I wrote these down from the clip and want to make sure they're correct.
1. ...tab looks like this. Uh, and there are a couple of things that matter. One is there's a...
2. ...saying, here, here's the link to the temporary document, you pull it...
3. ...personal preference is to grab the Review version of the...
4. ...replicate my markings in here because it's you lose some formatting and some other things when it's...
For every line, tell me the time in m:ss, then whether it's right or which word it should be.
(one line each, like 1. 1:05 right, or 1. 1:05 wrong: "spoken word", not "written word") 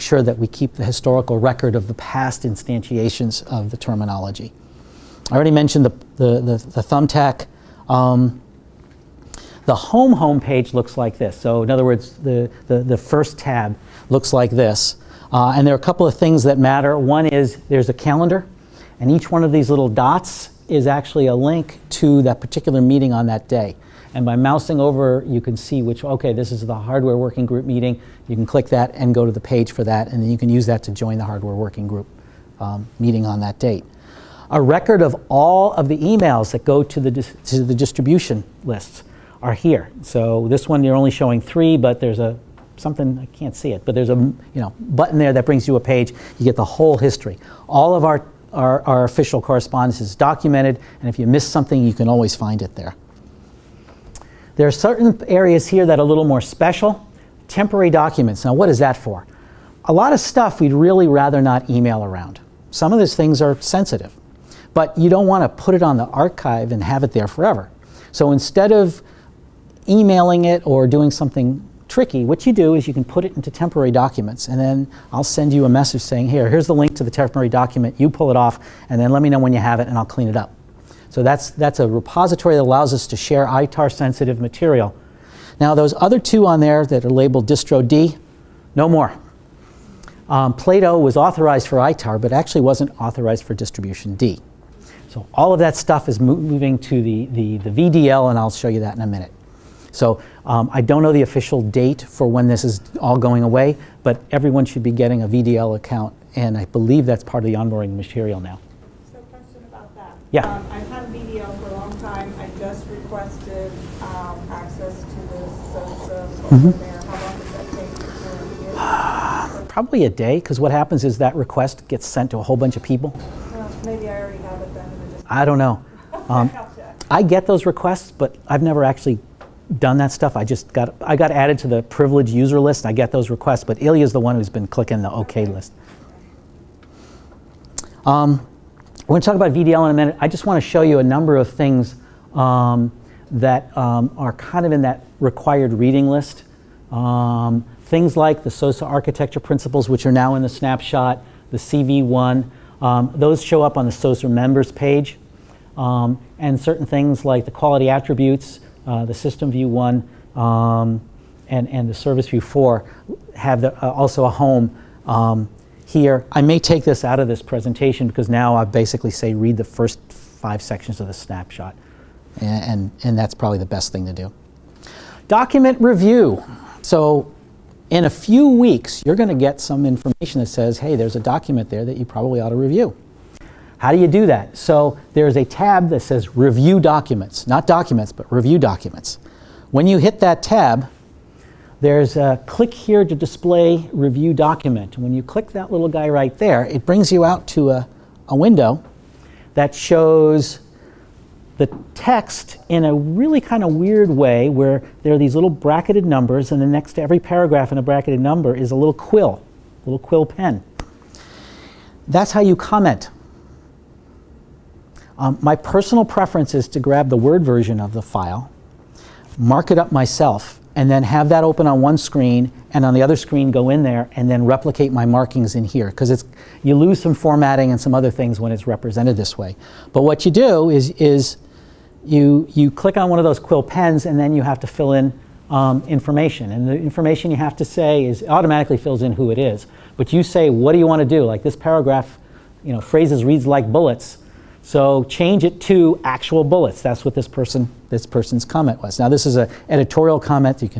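1. 0:13 right
2. 1:16 right
3. 3:35 wrong: "Word", not "Review"
4. 3:44 right.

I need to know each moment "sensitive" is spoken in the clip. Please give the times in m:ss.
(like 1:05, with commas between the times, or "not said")
1:03, 1:23.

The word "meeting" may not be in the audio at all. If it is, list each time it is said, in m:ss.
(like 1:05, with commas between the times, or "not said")
0:22, 0:27, 0:32.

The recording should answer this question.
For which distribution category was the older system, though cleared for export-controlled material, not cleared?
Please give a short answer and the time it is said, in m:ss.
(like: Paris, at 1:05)
Distribution D, at 1:33.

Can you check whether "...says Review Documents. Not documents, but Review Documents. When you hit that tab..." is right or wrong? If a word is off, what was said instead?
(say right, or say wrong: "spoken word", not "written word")
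right.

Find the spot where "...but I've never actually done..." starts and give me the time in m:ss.
2:08.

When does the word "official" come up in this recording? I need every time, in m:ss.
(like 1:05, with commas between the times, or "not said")
0:49, 1:41.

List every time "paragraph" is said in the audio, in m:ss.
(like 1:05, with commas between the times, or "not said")
3:27, 4:01.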